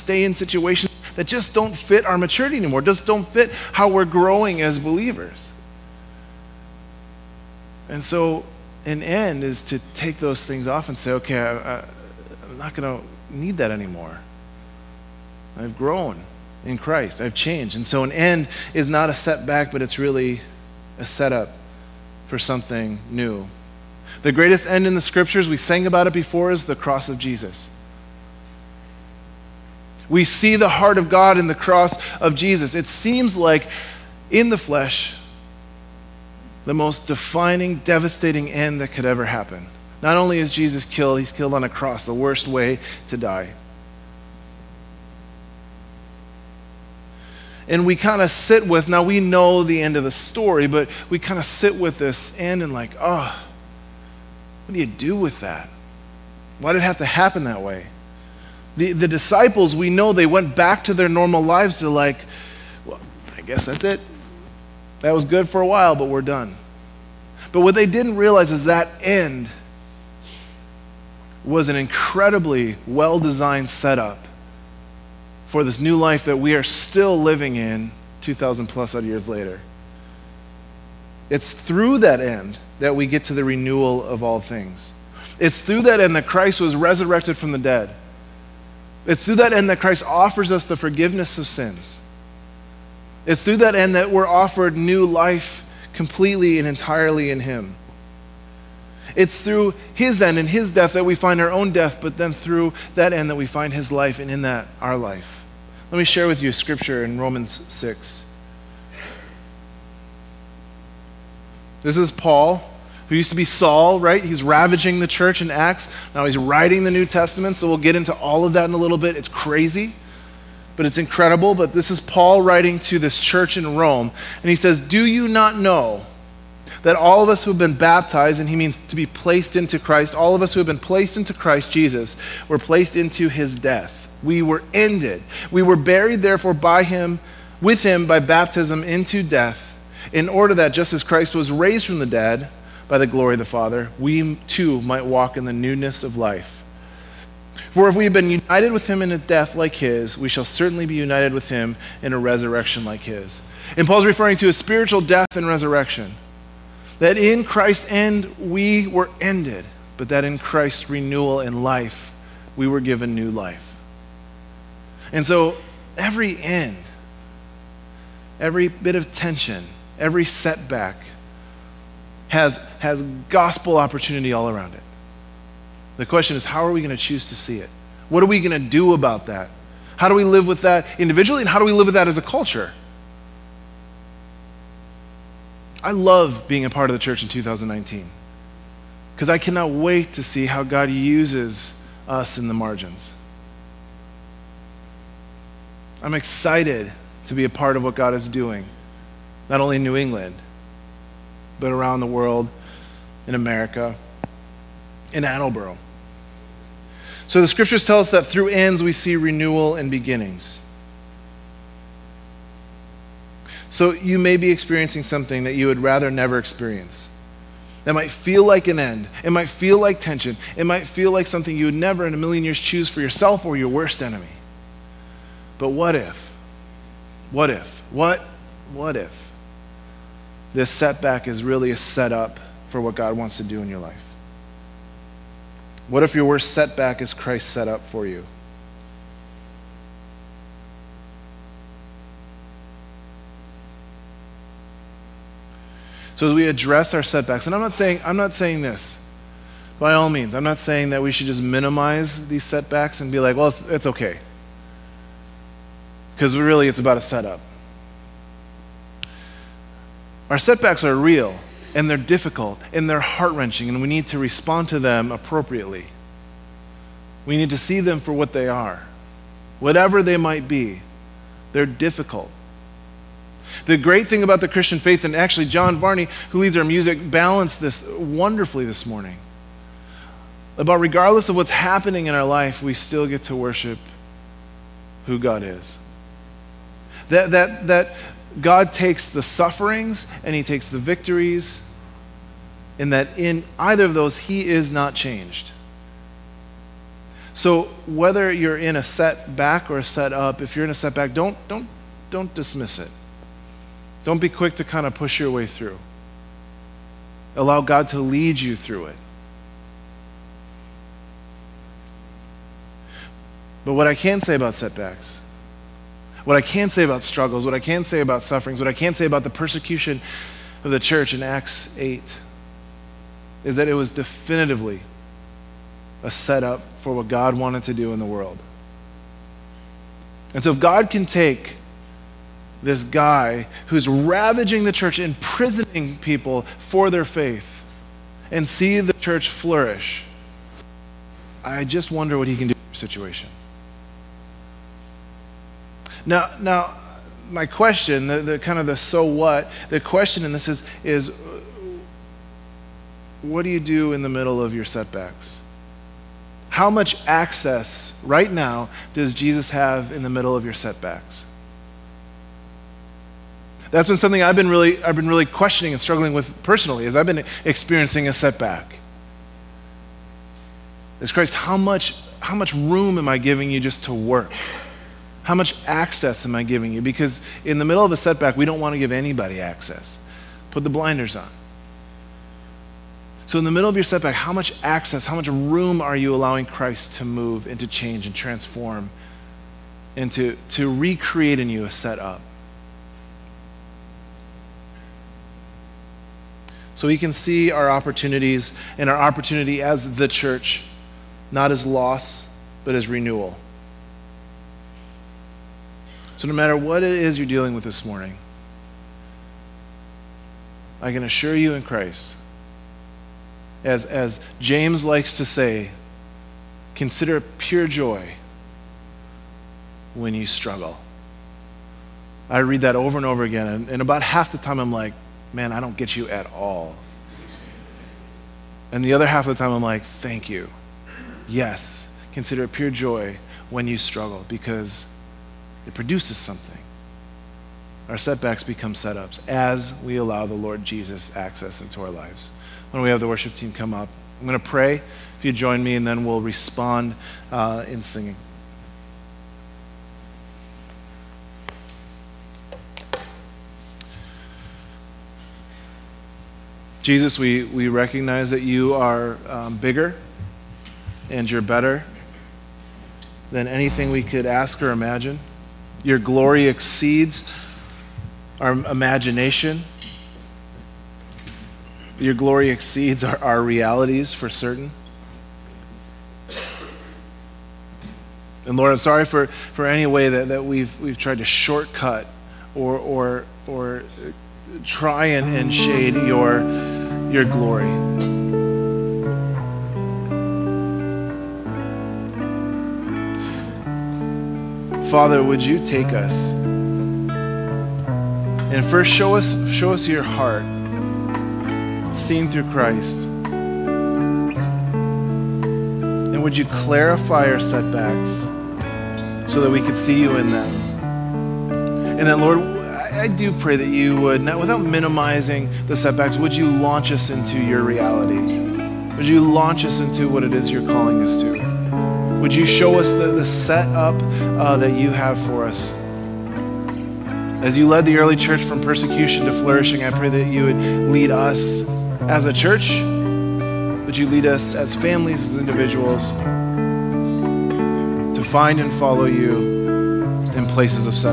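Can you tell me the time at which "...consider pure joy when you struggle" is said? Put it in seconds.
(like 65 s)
416 s.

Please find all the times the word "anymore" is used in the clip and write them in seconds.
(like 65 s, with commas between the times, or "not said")
2 s, 13 s.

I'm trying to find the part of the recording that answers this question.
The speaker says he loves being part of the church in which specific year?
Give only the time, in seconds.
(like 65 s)
187 s.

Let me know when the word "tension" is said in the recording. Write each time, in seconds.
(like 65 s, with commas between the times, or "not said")
169 s, 219 s.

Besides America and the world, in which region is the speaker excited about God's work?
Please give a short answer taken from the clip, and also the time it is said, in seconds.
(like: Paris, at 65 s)
New England, at 199 s.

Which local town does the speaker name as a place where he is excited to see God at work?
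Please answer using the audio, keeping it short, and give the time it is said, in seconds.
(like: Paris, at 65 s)
Attleboro, at 205 s.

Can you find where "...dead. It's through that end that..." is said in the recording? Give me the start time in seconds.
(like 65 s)
87 s.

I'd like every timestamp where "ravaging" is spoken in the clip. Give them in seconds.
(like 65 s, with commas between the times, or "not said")
114 s, 333 s.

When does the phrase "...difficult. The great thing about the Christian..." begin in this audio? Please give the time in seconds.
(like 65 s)
271 s.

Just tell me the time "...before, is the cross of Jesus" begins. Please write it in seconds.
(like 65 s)
26 s.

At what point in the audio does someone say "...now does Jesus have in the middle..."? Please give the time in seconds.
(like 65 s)
358 s.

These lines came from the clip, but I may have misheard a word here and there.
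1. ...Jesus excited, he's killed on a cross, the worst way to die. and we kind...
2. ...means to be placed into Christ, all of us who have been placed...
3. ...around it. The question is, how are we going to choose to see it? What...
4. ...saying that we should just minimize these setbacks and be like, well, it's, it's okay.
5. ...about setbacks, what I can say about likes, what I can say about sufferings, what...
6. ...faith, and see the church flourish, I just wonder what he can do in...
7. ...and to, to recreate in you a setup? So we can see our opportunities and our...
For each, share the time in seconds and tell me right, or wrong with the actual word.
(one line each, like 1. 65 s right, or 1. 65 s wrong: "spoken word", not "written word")
1. 40 s wrong: "killed", not "excited"
2. 128 s right
3. 174 s right
4. 250 s right
5. 314 s wrong: "struggles", not "likes"
6. 337 s right
7. 389 s right.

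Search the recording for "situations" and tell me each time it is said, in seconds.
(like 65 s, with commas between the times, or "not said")
0 s, 342 s.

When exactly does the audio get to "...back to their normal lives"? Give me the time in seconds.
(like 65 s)
60 s.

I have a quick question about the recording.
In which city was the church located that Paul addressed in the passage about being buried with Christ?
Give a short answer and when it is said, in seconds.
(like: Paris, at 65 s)
Rome, at 123 s.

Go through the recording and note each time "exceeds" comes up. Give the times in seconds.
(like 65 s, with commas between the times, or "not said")
466 s, 472 s.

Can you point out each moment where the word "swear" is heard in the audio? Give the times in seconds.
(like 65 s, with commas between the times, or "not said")
not said.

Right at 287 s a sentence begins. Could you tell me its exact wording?
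That, that, that God takes the sufferings and he takes the victories, and that in either of those, he is not changed.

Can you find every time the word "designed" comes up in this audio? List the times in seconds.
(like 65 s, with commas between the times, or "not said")
73 s.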